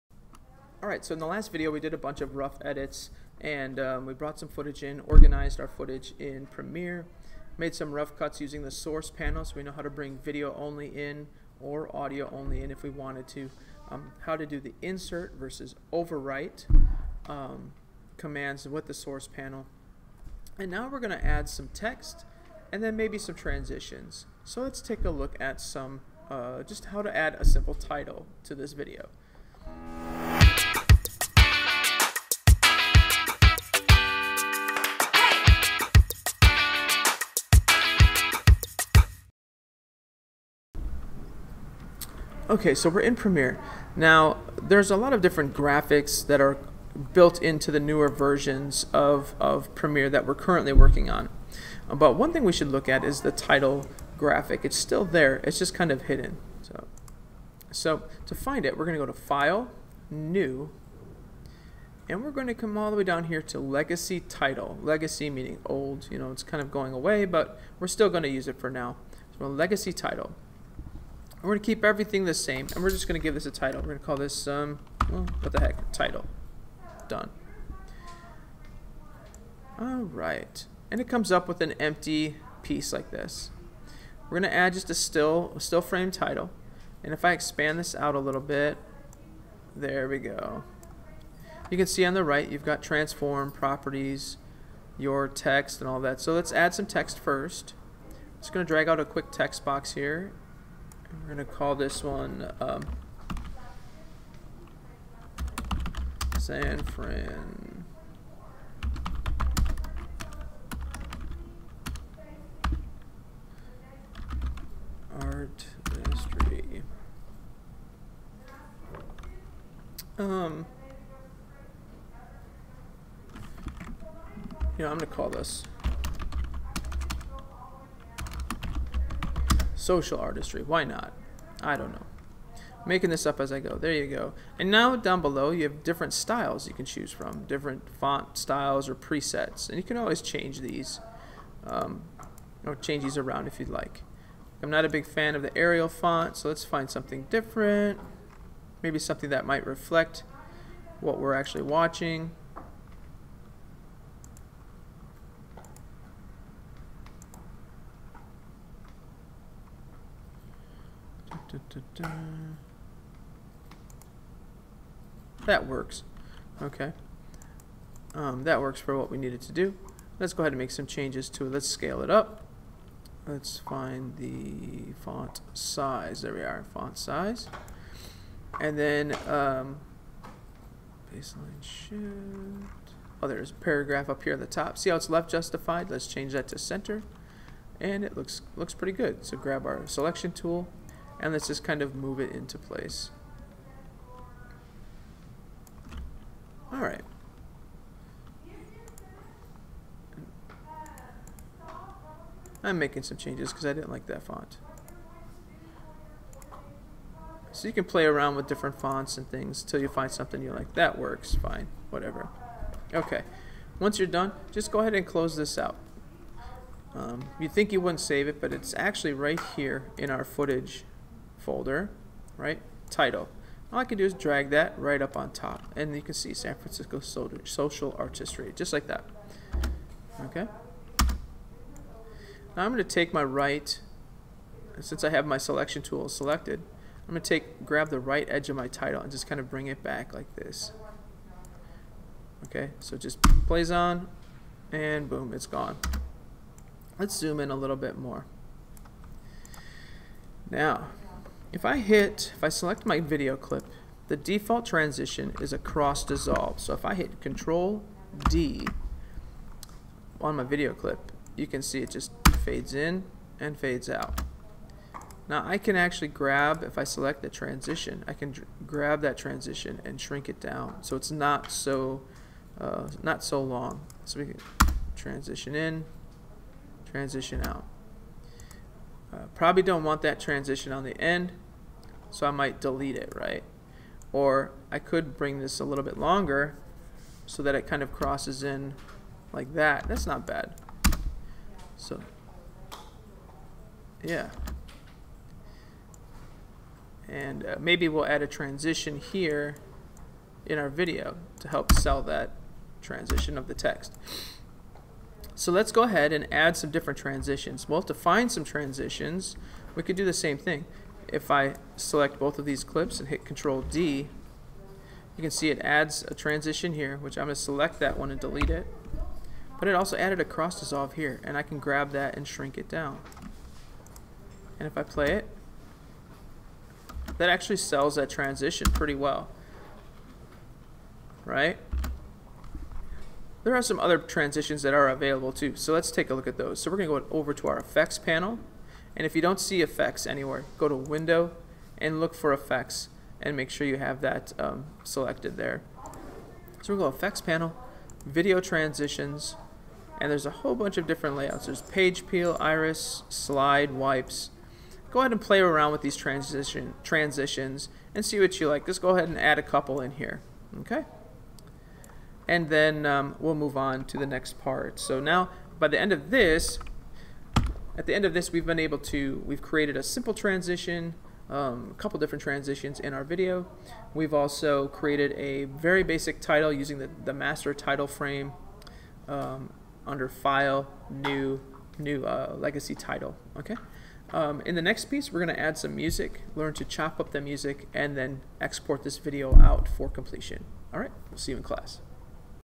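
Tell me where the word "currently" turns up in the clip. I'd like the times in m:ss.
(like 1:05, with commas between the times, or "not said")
0:50.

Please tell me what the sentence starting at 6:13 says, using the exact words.
We've also created a very basic title using the, the master title frame um, under File, New, New uh, Legacy Title.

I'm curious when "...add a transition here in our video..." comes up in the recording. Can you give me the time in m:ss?
4:58.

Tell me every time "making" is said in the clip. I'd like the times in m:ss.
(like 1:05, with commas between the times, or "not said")
2:12, 3:22.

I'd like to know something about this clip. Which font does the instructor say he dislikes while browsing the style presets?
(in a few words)
Arial.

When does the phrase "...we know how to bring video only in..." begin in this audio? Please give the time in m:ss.
0:09.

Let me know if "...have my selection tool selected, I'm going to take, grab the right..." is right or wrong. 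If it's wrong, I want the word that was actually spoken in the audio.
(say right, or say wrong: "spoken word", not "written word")
right.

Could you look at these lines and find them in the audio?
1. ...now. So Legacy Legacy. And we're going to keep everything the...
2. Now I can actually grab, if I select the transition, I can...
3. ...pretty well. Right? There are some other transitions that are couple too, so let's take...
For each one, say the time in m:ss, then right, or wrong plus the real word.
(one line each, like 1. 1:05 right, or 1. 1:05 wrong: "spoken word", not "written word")
1. 1:08 wrong: "Title", not "Legacy"
2. 4:25 right
3. 5:28 wrong: "available", not "couple".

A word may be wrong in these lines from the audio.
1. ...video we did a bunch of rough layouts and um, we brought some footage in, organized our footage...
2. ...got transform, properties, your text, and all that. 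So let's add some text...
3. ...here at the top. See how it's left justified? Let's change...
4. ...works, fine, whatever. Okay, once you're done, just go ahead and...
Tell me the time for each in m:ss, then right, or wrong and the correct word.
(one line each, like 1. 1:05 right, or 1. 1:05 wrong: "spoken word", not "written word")
1. 0:01 wrong: "edits", not "layouts"
2. 1:32 right
3. 3:04 right
4. 3:30 right.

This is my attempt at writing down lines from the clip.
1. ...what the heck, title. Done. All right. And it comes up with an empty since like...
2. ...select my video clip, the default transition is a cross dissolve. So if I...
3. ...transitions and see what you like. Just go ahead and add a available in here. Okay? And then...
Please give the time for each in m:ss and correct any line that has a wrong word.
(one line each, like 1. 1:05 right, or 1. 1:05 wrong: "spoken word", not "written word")
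1. 1:15 wrong: "piece", not "since"
2. 4:12 right
3. 5:56 wrong: "couple", not "available".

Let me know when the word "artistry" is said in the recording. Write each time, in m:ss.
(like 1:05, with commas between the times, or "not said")
2:10, 3:47.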